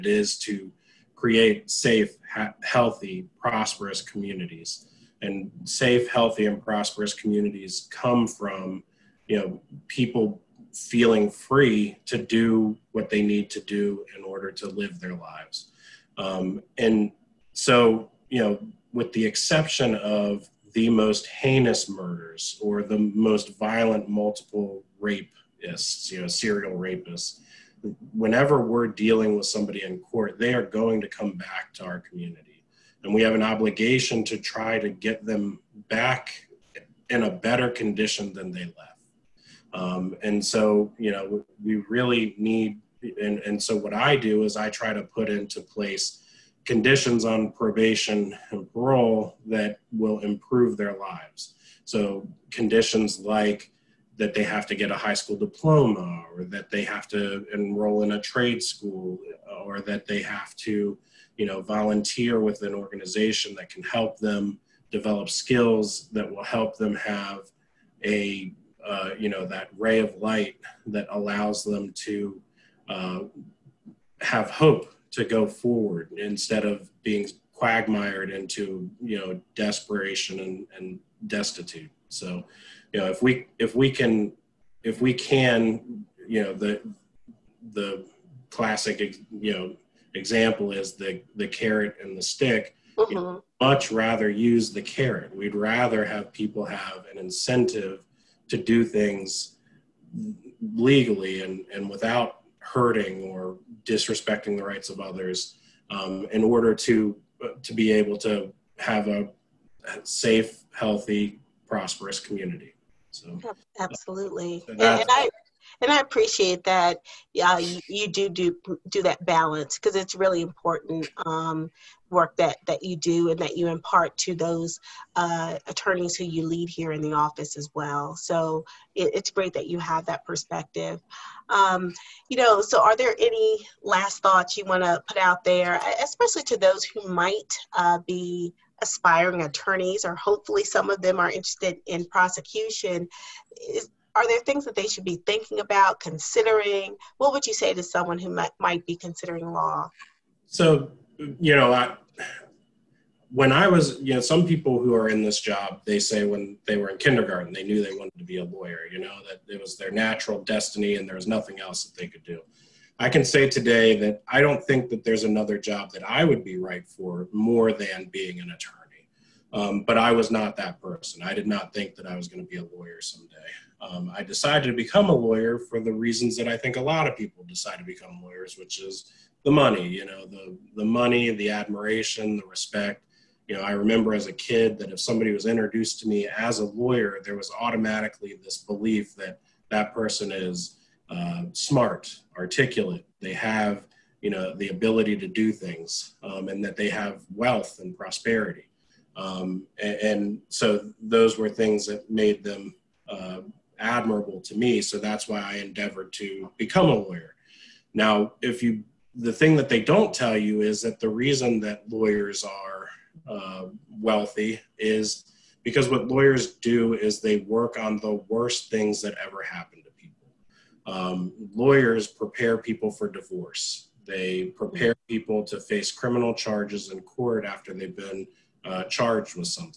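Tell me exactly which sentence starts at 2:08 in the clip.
So it, it's great that you have that perspective.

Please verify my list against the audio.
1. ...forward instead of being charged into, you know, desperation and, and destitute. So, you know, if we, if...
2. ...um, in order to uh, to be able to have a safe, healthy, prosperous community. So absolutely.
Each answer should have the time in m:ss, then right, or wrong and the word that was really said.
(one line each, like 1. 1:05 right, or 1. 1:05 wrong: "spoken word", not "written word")
1. 1:15 wrong: "quagmired", not "charged"
2. 1:45 right.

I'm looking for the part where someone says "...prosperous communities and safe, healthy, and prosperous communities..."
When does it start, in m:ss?
0:03.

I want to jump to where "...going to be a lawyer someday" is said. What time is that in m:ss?
2:52.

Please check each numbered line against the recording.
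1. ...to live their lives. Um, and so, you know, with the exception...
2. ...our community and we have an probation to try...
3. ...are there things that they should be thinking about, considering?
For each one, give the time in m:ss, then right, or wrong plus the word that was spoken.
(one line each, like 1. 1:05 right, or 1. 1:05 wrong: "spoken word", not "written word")
1. 0:14 right
2. 0:31 wrong: "obligation", not "probation"
3. 2:24 right.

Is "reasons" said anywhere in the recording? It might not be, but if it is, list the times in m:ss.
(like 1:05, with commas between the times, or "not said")
2:55, 3:31.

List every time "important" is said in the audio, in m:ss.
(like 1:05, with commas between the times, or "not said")
2:00.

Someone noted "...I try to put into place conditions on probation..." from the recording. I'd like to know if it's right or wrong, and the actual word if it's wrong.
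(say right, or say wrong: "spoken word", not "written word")
right.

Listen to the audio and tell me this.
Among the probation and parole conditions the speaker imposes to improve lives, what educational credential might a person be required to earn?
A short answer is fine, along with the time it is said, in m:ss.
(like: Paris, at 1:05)
High school diploma, at 0:54.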